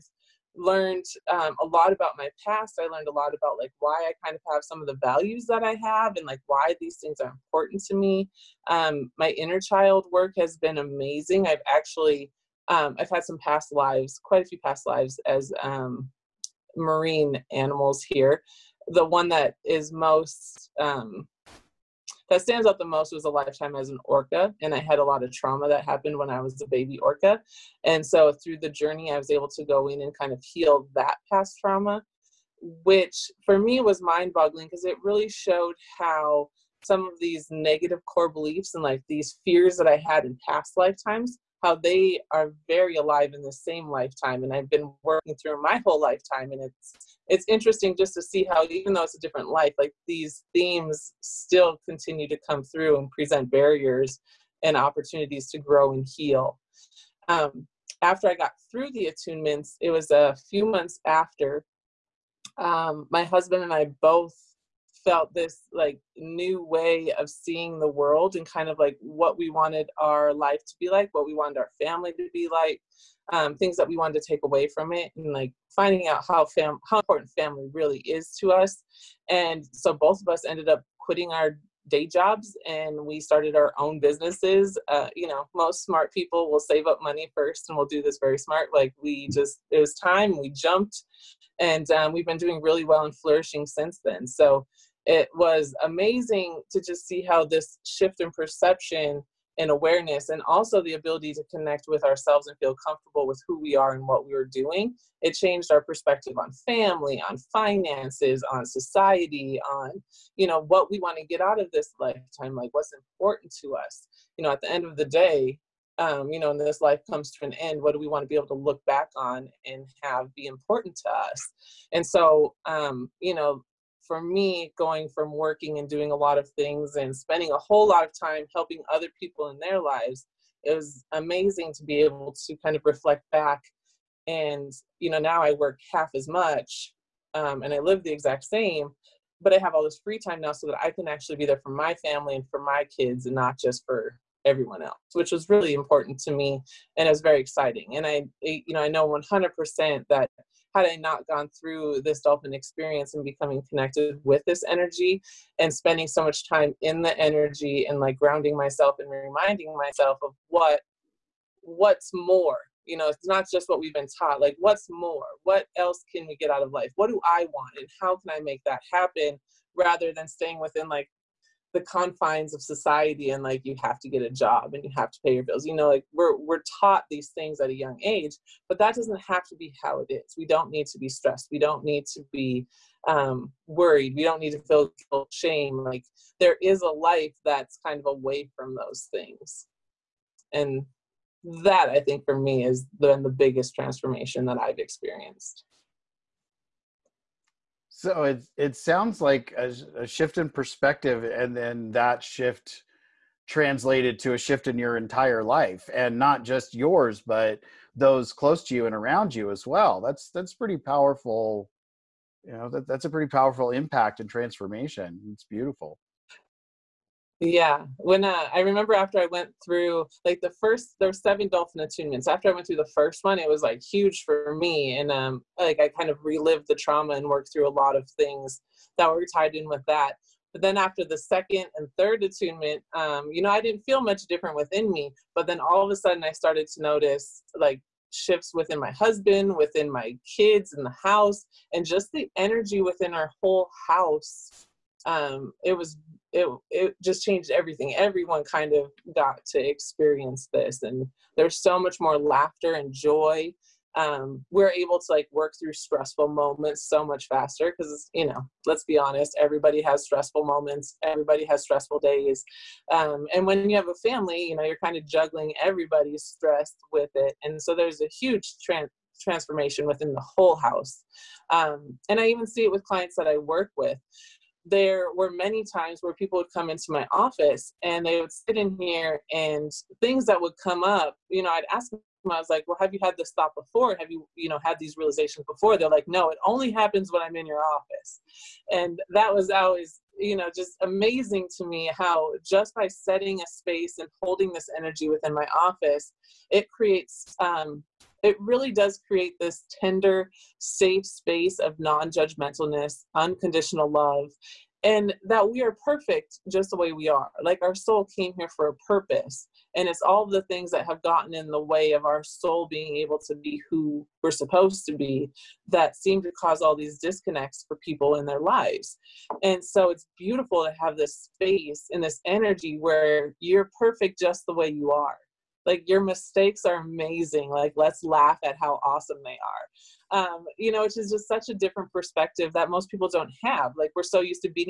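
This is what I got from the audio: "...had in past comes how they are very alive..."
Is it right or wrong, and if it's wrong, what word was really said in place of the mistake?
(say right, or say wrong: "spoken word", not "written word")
wrong: "lifetimes", not "comes".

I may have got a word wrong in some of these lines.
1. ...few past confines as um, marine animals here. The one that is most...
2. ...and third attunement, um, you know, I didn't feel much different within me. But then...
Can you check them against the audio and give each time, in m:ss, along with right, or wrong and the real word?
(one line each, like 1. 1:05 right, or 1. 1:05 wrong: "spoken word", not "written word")
1. 0:14 wrong: "lives", not "confines"
2. 3:51 right.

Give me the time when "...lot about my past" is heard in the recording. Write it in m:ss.
0:01.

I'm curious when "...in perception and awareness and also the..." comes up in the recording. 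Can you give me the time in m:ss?
1:38.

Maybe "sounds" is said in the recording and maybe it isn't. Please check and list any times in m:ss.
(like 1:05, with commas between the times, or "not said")
3:18.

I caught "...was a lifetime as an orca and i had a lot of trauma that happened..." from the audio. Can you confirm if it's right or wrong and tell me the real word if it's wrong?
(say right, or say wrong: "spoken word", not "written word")
right.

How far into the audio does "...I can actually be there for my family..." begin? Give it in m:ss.
2:20.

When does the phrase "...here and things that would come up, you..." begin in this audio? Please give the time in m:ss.
4:38.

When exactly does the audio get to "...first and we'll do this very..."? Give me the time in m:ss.
1:27.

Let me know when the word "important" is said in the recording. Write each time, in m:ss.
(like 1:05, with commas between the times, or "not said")
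0:07, 1:16, 1:52, 2:00, 2:25.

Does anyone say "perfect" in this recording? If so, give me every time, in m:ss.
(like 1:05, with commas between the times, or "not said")
5:05, 5:23.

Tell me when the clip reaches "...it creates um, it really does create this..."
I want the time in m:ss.
4:56.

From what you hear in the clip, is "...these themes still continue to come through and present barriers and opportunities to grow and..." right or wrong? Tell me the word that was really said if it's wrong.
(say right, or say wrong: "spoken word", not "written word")
right.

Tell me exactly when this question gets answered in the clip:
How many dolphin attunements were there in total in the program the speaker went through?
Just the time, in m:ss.
3:41.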